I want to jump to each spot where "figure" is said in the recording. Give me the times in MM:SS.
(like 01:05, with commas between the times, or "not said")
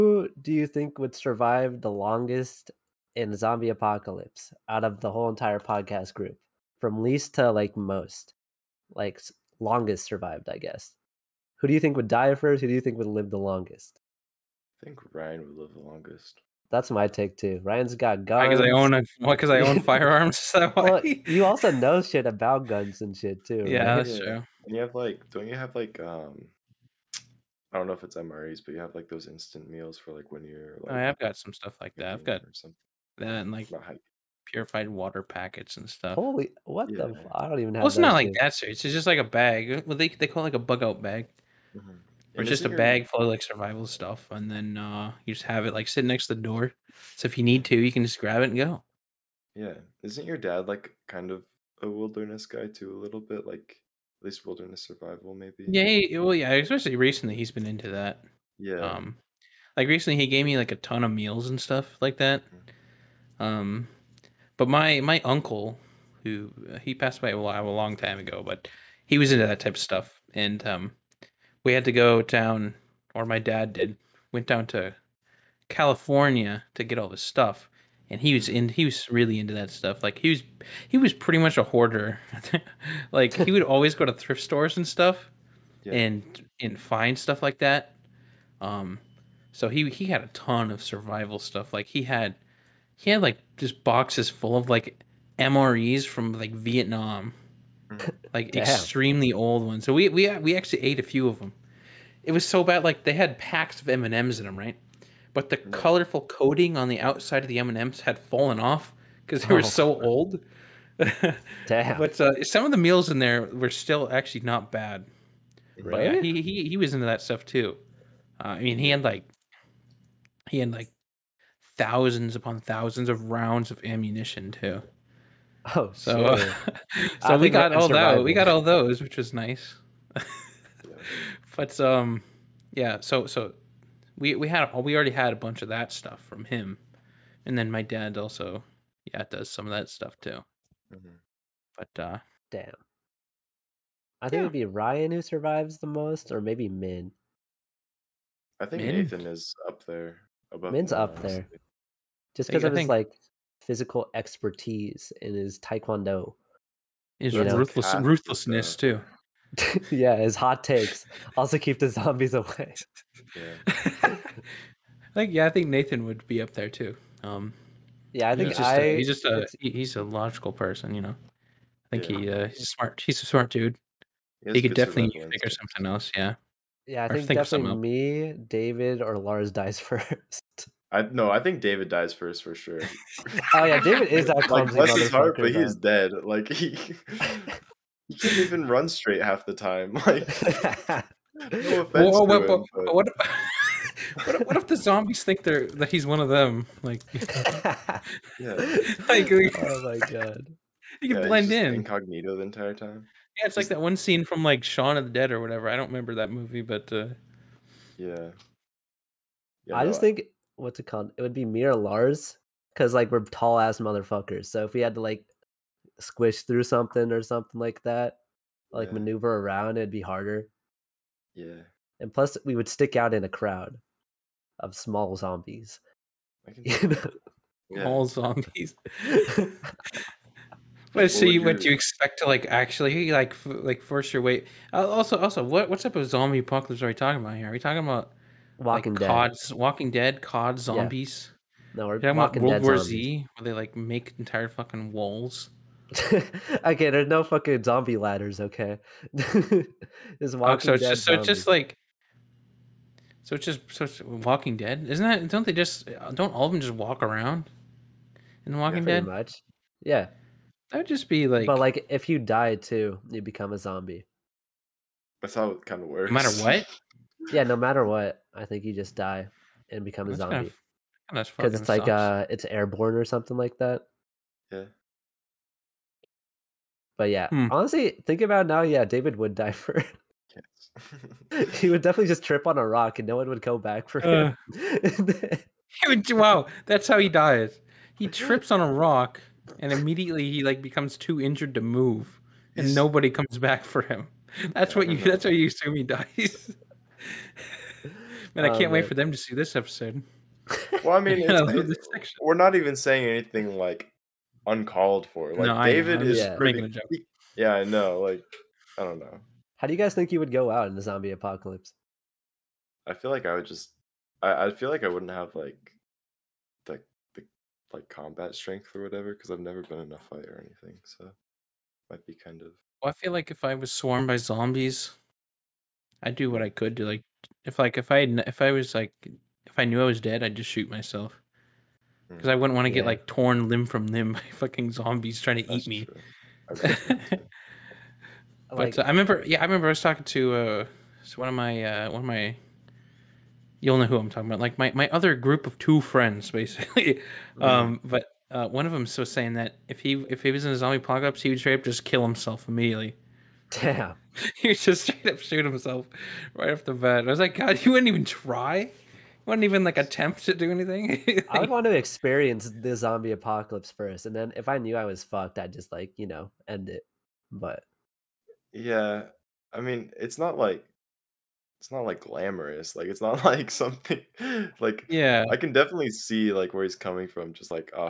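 02:55.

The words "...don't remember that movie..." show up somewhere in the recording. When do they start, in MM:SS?
03:25.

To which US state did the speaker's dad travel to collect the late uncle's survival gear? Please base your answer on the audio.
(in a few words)
California.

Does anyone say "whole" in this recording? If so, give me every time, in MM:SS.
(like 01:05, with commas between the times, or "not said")
00:05.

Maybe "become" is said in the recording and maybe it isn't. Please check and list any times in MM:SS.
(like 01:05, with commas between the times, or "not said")
04:23, 04:29, 04:50.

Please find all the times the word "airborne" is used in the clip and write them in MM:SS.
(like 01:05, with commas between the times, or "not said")
04:32.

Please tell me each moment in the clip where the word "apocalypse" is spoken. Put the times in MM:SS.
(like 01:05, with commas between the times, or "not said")
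00:03, 03:56, 05:11, 05:50, 06:03.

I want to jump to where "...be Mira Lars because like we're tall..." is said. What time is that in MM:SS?
03:31.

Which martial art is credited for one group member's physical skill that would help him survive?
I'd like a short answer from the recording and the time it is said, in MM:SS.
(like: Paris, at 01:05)
taekwondo, at 02:35.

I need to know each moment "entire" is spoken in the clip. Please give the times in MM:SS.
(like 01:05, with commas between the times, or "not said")
00:05, 03:22, 04:04.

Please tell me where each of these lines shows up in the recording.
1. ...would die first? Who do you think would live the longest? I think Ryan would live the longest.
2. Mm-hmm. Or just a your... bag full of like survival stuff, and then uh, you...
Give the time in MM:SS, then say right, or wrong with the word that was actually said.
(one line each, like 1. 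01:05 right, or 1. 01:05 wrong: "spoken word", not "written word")
1. 00:11 right
2. 00:41 right.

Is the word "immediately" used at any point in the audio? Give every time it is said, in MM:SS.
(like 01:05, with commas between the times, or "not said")
04:49, 05:52.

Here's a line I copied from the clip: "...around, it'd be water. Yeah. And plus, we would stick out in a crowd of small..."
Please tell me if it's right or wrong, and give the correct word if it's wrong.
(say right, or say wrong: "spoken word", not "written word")
wrong: "harder", not "water".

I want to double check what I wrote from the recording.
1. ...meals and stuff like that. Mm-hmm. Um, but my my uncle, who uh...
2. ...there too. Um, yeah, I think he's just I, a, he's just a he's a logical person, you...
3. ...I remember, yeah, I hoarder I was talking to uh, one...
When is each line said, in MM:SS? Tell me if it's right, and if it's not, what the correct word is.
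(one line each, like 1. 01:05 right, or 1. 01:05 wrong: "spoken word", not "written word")
1. 01:01 right
2. 02:46 right
3. 05:38 wrong: "remember", not "hoarder".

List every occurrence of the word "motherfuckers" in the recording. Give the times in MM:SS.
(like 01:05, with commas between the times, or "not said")
03:33.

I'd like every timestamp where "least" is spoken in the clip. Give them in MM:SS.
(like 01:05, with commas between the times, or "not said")
00:07, 00:54.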